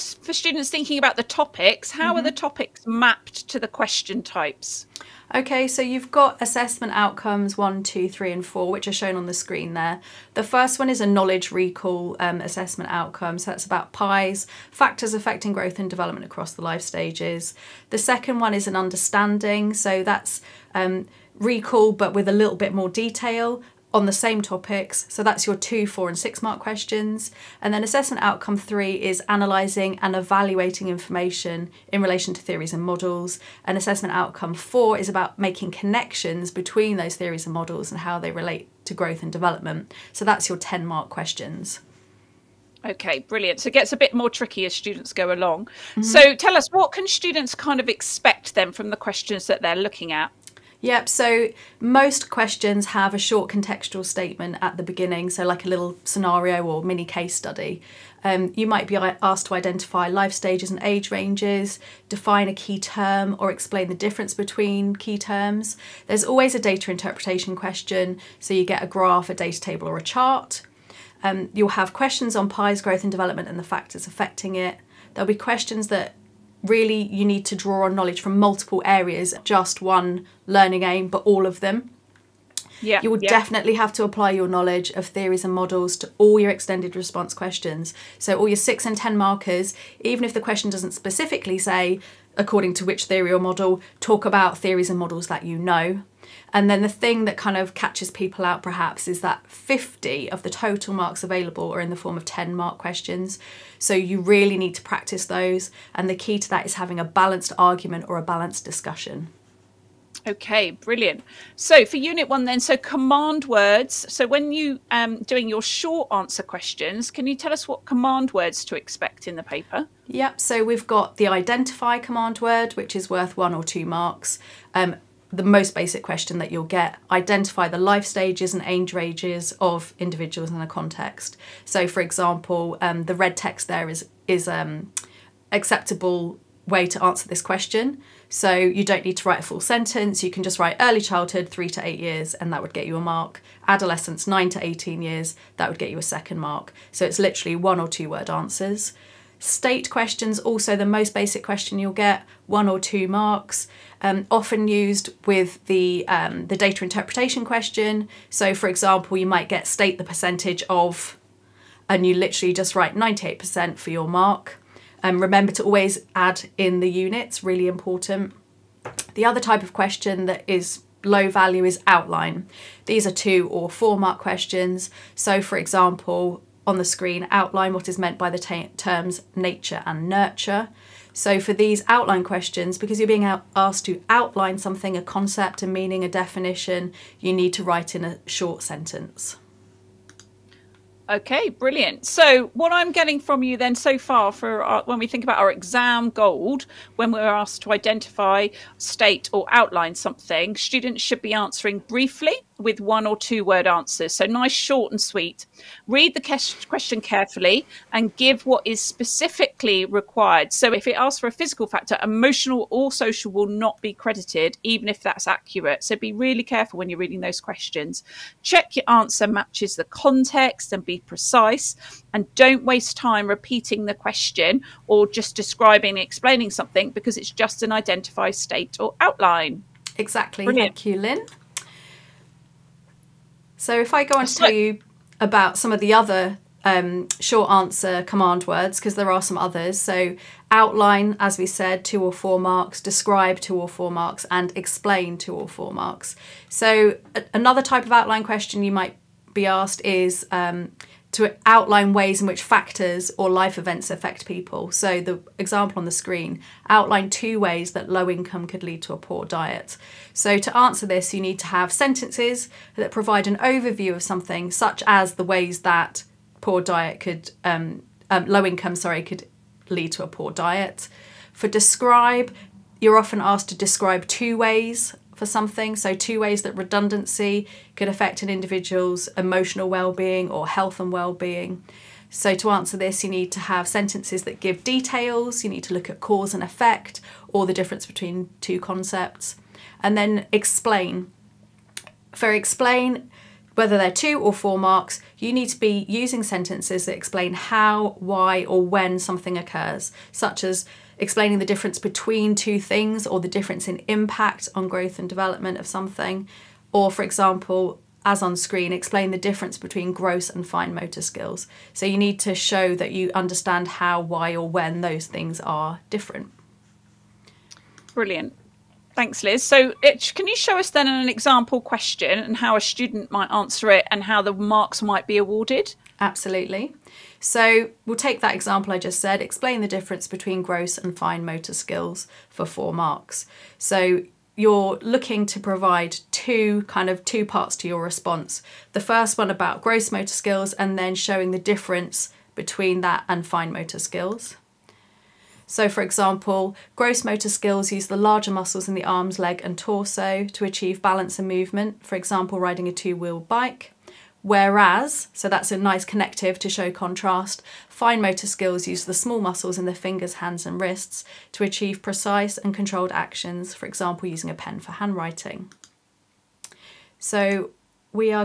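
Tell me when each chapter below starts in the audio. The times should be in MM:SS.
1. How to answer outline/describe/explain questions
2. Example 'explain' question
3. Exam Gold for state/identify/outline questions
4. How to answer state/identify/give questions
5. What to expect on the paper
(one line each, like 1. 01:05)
1. 03:55
2. 05:15
3. 03:15
4. 01:55
5. 00:45.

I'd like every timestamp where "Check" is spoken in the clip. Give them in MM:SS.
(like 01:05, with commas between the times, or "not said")
03:38.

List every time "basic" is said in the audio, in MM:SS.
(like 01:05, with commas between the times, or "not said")
02:05, 02:31.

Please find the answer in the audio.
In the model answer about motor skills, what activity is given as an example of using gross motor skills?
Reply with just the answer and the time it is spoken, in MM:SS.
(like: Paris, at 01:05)
riding a two wheeled bike, at 05:52.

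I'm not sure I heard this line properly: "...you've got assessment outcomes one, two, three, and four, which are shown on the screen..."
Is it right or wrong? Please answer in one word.
right.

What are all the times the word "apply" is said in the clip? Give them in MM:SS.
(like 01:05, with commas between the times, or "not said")
01:24.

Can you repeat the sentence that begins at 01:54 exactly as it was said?
So when you um, doing your short answer questions, can you tell us what command words to expect in the paper?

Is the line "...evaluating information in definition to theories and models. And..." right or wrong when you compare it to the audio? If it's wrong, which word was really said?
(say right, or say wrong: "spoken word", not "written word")
wrong: "relation", not "definition".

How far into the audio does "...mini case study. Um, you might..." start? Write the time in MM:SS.
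00:56.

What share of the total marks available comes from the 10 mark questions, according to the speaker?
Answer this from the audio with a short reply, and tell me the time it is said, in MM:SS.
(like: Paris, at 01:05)
50, at 01:39.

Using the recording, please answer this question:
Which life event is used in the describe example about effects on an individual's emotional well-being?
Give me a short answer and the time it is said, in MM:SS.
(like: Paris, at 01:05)
redundancy, at 04:36.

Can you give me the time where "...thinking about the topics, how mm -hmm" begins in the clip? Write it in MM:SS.
00:00.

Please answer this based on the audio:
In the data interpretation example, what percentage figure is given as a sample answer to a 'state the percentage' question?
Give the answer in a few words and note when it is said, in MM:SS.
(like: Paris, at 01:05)
98%, at 02:42.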